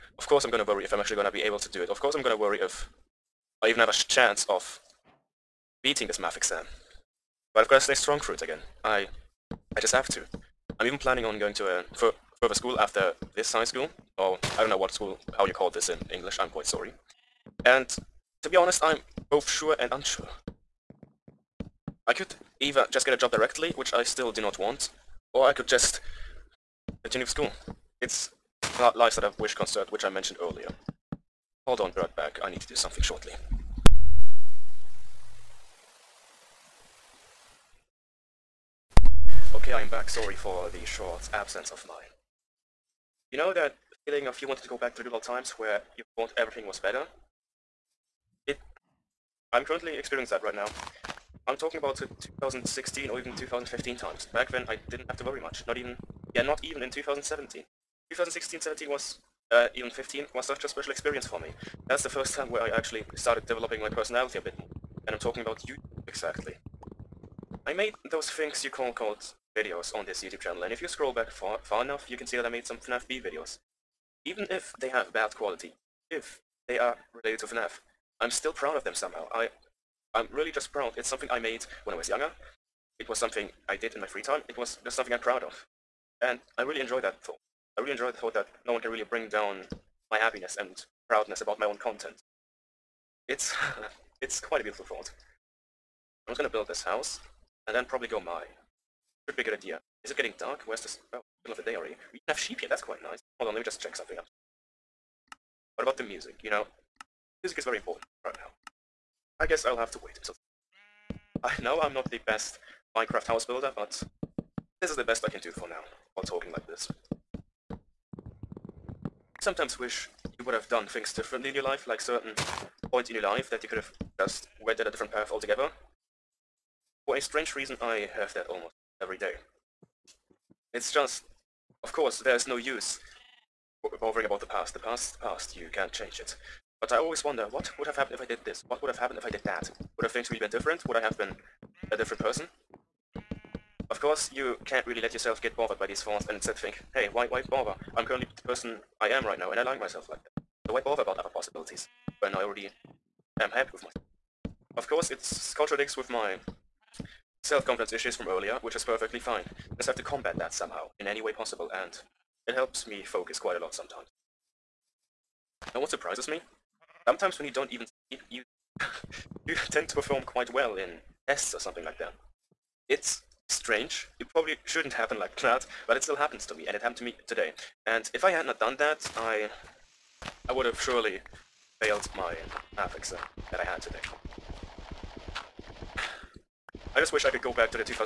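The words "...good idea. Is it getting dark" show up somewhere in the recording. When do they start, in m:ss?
1:39.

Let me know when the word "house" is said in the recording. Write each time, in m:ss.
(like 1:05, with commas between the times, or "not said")
1:36, 1:53.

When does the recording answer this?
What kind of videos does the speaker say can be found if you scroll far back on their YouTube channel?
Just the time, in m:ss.
1:12.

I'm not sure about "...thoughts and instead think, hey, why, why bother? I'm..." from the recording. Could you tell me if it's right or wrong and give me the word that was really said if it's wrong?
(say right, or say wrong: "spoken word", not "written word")
right.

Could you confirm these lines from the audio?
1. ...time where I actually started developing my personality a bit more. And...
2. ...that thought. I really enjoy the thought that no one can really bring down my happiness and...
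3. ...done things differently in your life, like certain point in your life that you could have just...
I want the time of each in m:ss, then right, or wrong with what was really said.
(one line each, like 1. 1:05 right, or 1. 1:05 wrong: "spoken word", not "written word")
1. 1:02 right
2. 1:26 right
3. 2:00 right.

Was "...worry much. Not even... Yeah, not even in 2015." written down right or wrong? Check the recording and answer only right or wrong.
wrong.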